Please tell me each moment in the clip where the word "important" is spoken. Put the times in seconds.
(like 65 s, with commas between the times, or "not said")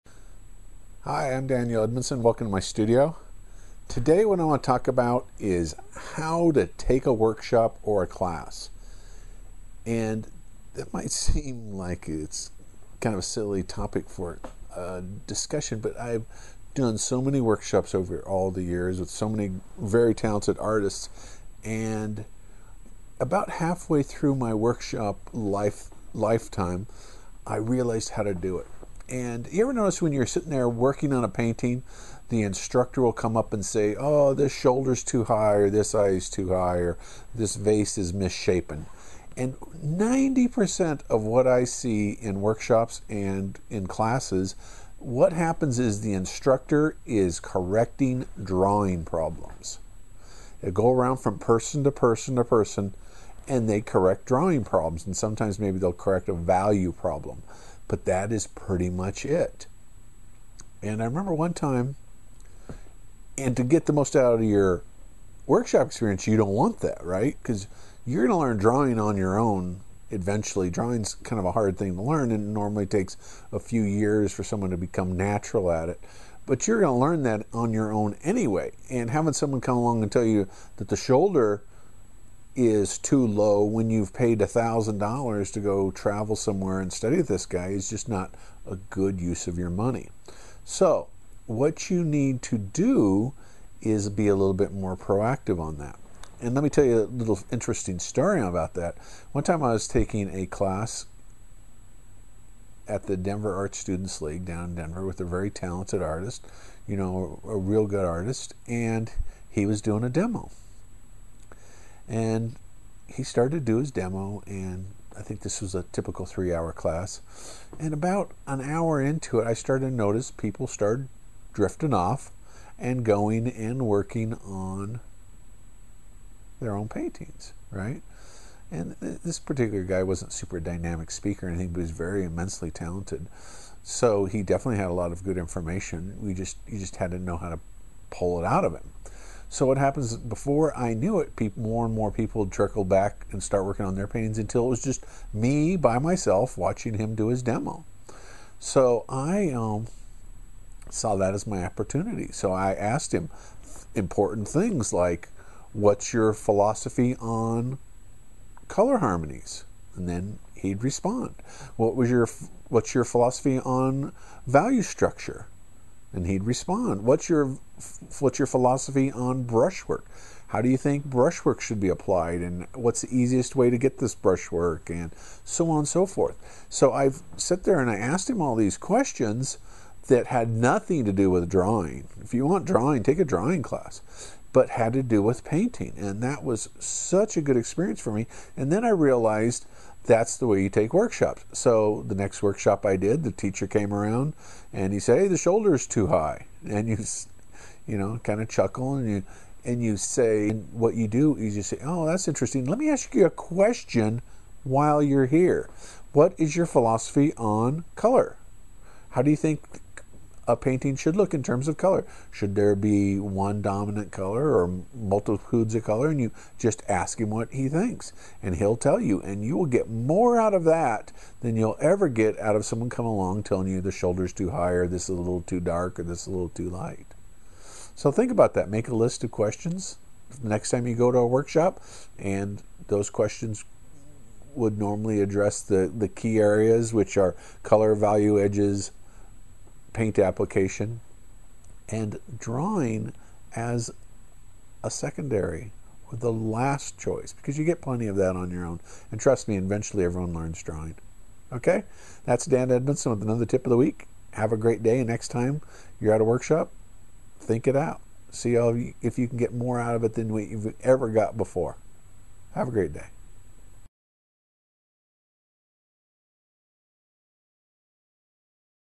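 153 s.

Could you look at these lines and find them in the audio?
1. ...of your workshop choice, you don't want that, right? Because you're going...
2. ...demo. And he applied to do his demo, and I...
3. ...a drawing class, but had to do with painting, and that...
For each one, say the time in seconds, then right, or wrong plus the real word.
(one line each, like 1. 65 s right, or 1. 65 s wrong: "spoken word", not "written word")
1. 64 s wrong: "experience", not "choice"
2. 110 s wrong: "started", not "applied"
3. 183 s right.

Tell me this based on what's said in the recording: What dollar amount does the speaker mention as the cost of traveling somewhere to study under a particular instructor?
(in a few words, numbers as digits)
$1,000.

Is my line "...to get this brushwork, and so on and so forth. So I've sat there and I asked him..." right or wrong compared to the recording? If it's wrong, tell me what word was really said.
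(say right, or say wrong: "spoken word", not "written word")
right.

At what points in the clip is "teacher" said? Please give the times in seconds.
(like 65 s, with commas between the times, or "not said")
193 s.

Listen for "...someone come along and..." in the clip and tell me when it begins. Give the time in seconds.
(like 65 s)
79 s.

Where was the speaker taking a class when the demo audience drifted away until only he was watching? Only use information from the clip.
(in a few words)
Denver Art Students League.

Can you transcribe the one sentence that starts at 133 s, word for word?
So he definitely had a lot of good information.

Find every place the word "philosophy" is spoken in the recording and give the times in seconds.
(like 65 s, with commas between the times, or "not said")
156 s, 163 s, 168 s, 206 s.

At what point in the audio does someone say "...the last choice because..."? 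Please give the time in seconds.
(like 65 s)
246 s.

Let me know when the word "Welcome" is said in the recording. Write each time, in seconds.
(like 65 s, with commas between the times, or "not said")
2 s.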